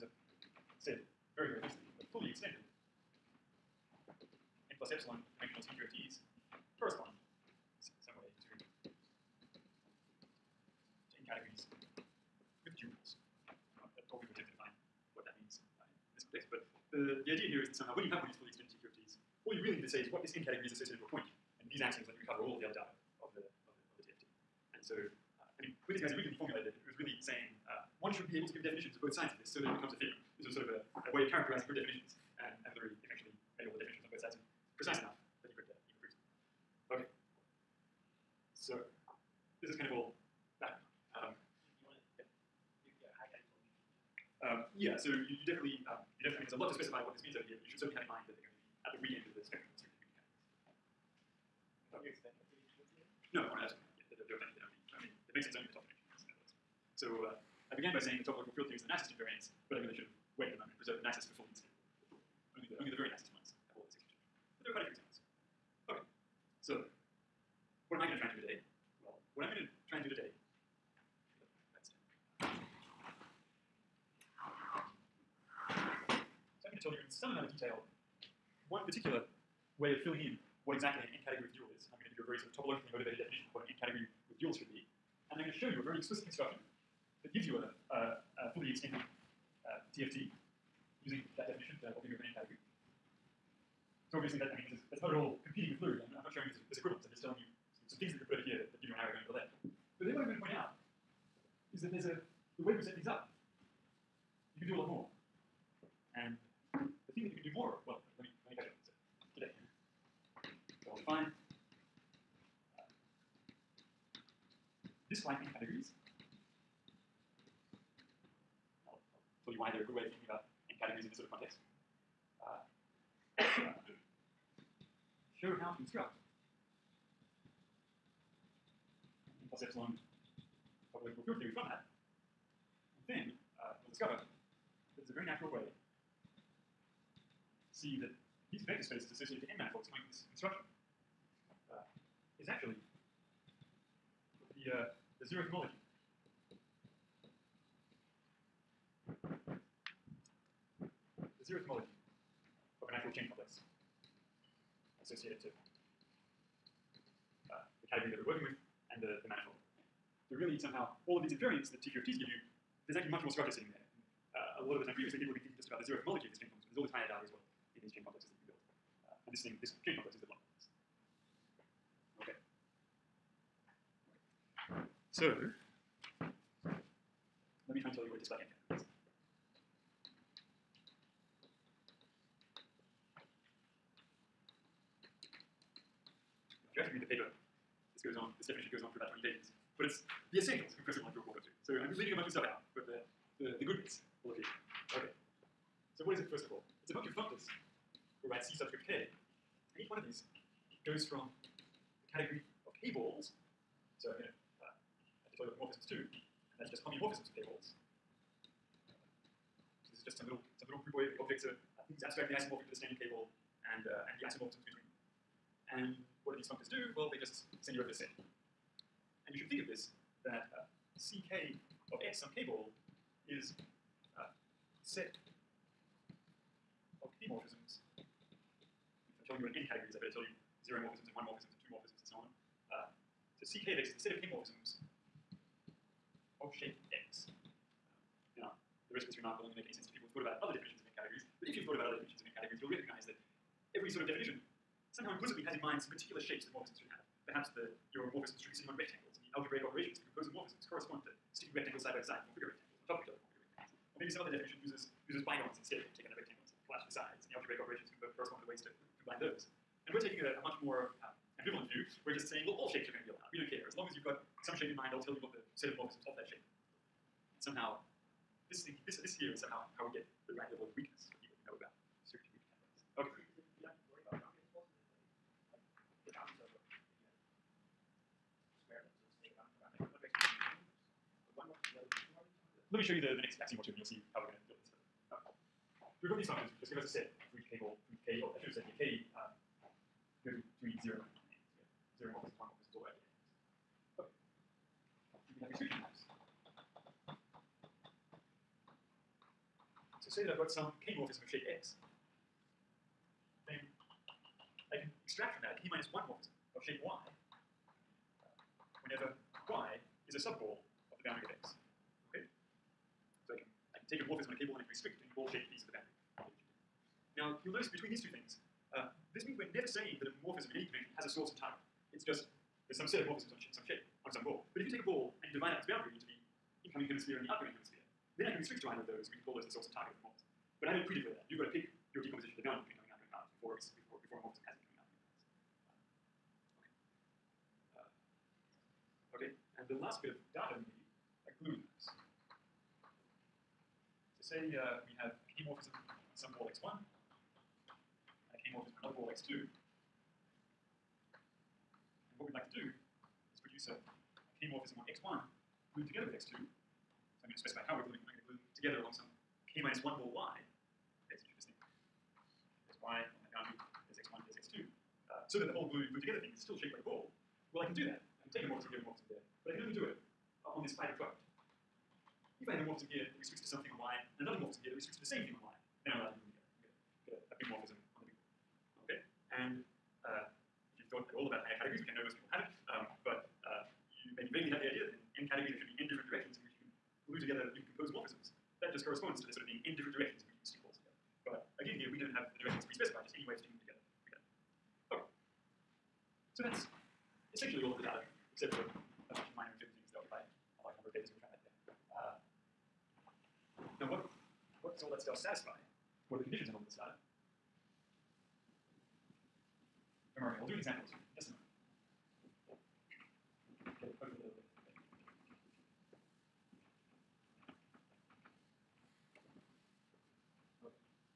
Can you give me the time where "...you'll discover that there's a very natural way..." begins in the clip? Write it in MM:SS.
02:13.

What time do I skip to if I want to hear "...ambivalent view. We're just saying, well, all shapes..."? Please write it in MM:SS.
04:21.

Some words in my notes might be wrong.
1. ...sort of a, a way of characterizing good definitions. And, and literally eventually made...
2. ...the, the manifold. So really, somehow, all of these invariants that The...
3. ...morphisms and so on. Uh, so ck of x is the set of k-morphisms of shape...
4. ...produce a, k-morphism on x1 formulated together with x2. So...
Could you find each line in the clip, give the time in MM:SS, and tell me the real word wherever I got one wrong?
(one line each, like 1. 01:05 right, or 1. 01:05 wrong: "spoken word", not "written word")
1. 00:30 right
2. 02:39 wrong: "TQFTs", not "The"
3. 03:51 right
4. 05:53 wrong: "glued", not "formulated".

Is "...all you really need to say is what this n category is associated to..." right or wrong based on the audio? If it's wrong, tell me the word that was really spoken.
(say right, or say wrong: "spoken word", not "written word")
right.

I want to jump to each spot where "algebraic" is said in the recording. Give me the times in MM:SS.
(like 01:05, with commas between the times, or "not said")
04:09, 04:17.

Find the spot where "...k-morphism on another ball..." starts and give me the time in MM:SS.
05:48.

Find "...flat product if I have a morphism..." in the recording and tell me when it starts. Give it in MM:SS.
06:10.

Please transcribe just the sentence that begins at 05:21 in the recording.
It's just there's some set of morphisms on sh some shape, on some ball.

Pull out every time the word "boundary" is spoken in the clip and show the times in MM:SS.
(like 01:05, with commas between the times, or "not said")
05:11, 05:25, 05:32, 06:03.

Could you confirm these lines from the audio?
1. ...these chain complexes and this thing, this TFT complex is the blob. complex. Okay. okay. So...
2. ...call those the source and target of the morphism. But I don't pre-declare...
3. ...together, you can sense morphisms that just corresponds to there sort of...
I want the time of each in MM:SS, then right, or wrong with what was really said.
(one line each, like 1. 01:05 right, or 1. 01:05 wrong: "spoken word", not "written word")
1. 02:47 wrong: "Cuny", not "TFT"
2. 05:29 right
3. 06:27 wrong: "compose", not "sense".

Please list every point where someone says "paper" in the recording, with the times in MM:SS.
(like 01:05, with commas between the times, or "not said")
03:07.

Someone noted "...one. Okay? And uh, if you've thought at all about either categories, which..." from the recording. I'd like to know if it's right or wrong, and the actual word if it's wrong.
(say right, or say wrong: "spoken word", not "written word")
wrong: "higher", not "either".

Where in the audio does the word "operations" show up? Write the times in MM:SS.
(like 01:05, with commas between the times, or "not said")
04:09, 04:17.